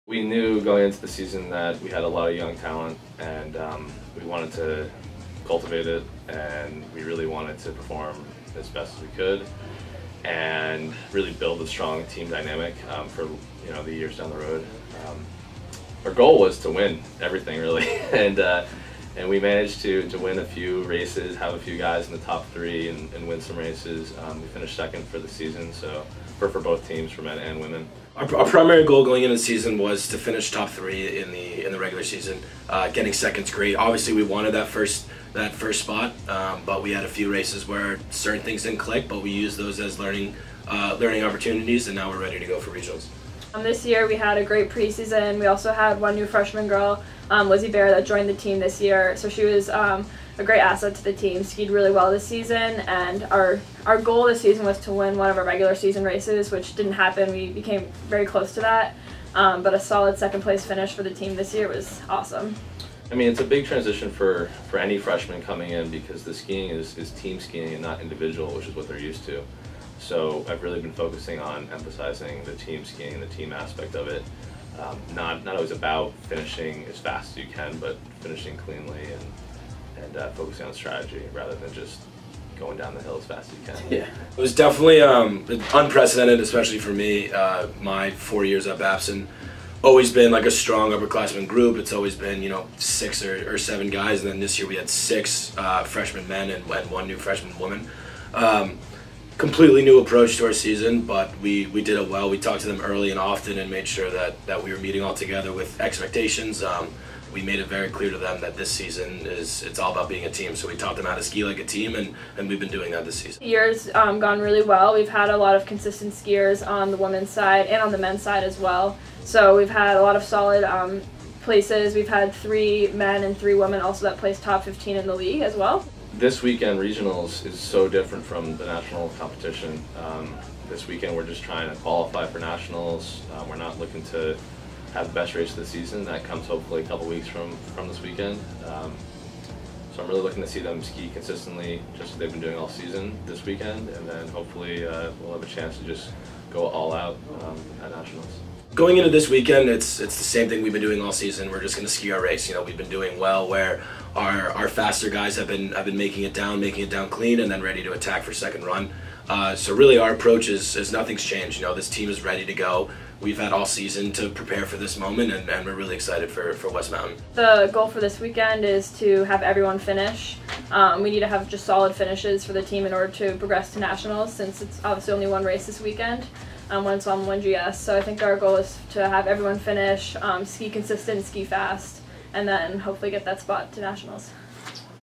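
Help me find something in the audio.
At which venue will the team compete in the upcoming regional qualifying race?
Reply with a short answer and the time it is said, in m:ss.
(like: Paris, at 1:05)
West Mountain, at 2:46.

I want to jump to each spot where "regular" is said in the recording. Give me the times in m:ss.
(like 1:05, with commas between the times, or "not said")
0:31, 0:55.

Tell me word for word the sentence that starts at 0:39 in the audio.
But we used those as learning uh, learning opportunities, and now we're ready to go for regionals.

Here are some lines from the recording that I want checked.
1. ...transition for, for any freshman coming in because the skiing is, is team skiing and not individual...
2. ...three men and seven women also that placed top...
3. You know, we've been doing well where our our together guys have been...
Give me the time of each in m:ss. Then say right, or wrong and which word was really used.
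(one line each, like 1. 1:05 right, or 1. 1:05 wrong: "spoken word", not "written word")
1. 1:03 right
2. 2:02 wrong: "three", not "seven"
3. 2:32 wrong: "faster", not "together".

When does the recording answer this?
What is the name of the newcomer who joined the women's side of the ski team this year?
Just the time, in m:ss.
0:47.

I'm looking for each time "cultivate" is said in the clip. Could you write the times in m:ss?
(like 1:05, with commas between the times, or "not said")
0:05.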